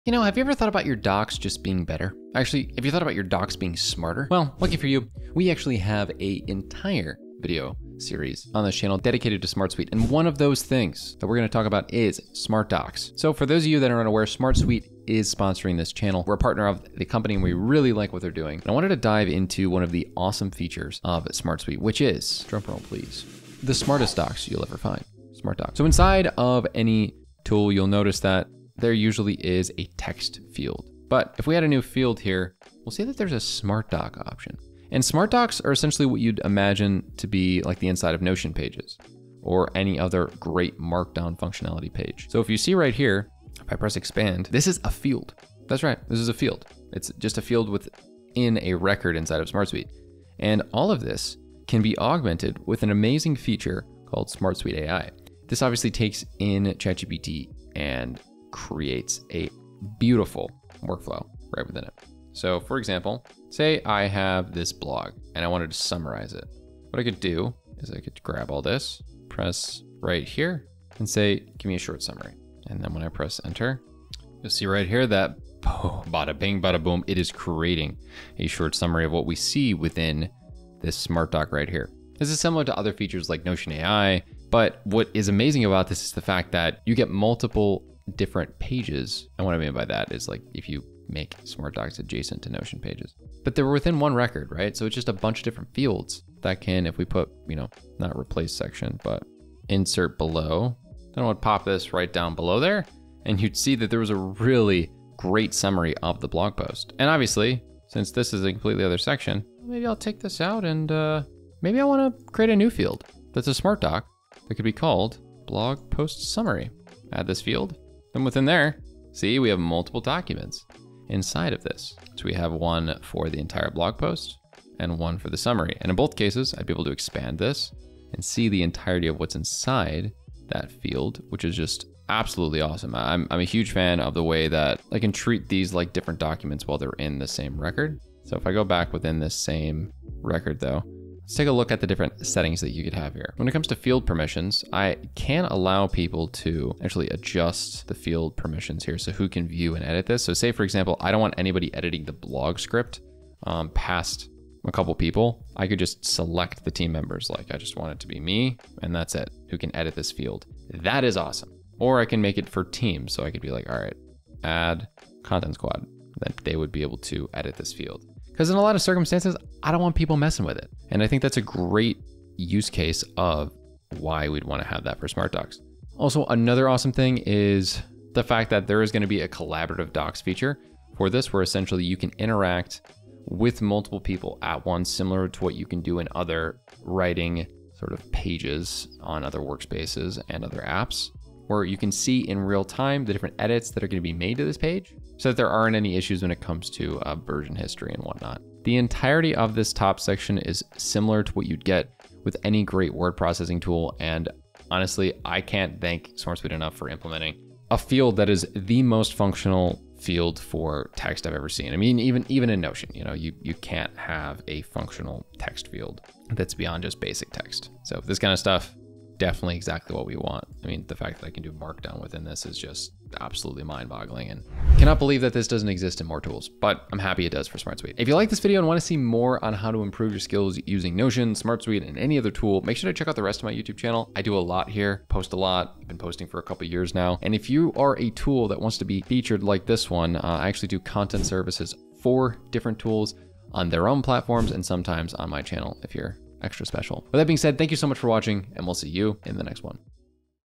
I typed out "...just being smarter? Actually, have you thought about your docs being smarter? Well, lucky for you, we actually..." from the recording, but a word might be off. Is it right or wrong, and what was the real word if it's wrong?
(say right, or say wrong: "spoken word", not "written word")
wrong: "better", not "smarter".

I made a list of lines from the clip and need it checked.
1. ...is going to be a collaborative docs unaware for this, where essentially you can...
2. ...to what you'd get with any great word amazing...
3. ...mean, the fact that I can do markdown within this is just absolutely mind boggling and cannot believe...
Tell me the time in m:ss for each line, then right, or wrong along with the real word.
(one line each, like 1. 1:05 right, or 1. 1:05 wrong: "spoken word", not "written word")
1. 2:58 wrong: "feature", not "unaware"
2. 3:21 wrong: "processing", not "amazing"
3. 3:40 right.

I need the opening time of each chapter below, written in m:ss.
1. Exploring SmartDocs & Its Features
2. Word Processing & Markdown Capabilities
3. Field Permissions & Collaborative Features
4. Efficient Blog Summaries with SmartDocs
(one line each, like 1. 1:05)
1. 0:33
2. 3:16
3. 2:14
4. 1:15.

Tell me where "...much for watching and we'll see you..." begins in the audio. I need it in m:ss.
4:07.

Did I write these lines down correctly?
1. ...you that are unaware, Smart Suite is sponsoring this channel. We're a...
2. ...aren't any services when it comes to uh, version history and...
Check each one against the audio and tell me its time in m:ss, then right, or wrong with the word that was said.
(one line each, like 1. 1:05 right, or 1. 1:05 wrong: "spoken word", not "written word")
1. 0:13 right
2. 3:15 wrong: "issues", not "services".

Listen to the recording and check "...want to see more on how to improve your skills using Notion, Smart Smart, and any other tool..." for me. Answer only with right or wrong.
wrong.